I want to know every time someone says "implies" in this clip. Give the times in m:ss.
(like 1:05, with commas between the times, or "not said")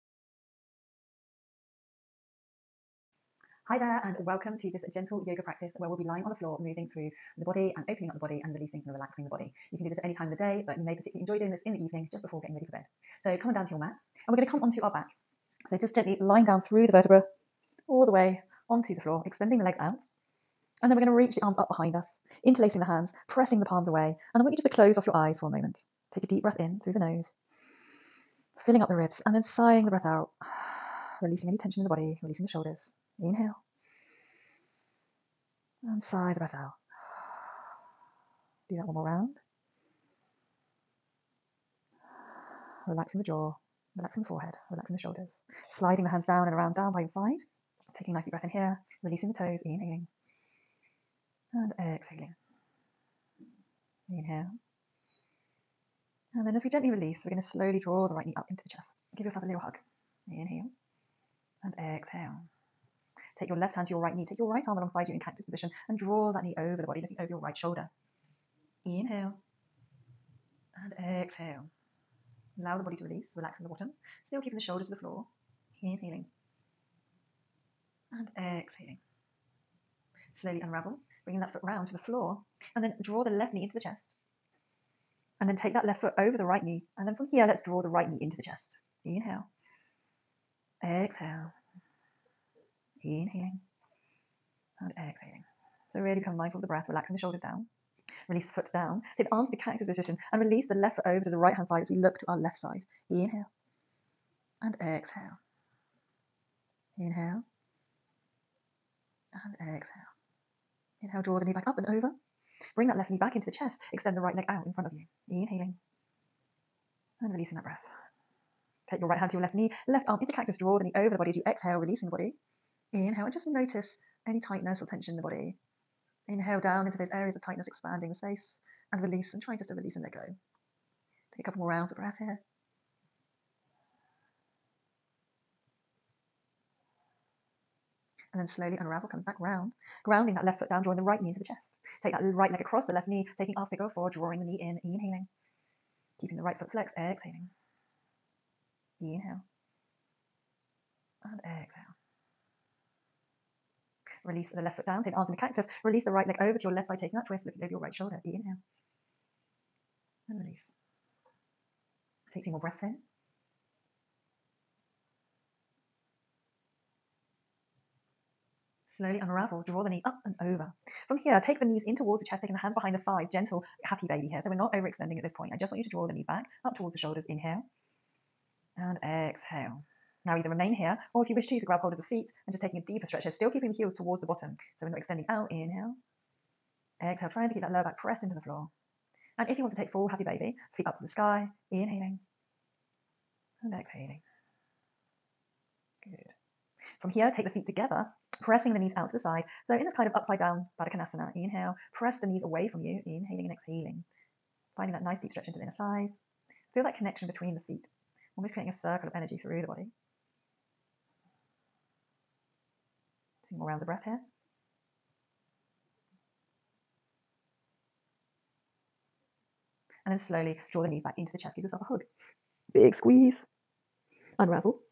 not said.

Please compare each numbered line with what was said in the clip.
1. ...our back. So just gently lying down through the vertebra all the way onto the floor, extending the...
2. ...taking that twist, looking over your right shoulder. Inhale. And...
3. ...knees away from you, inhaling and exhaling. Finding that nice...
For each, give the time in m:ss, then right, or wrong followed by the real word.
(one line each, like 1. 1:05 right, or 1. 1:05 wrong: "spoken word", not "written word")
1. 0:14 right
2. 2:37 right
3. 3:22 right.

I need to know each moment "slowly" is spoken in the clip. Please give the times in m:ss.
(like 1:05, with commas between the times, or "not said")
0:57, 1:20, 2:18, 2:49, 3:40.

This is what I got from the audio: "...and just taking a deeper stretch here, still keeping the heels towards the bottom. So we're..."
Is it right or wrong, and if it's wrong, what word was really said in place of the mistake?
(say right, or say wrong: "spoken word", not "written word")
right.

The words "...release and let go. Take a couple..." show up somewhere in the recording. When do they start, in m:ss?
2:09.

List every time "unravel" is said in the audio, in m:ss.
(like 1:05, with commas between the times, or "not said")
1:20, 2:18, 2:49, 3:44.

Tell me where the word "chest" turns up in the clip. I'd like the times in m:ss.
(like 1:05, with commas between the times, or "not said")
0:58, 1:23, 1:28, 1:53, 2:21, 2:52, 3:41.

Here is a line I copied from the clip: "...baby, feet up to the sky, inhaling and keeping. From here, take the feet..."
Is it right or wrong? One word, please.
wrong.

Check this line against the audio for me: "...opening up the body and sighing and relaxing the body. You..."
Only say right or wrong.
wrong.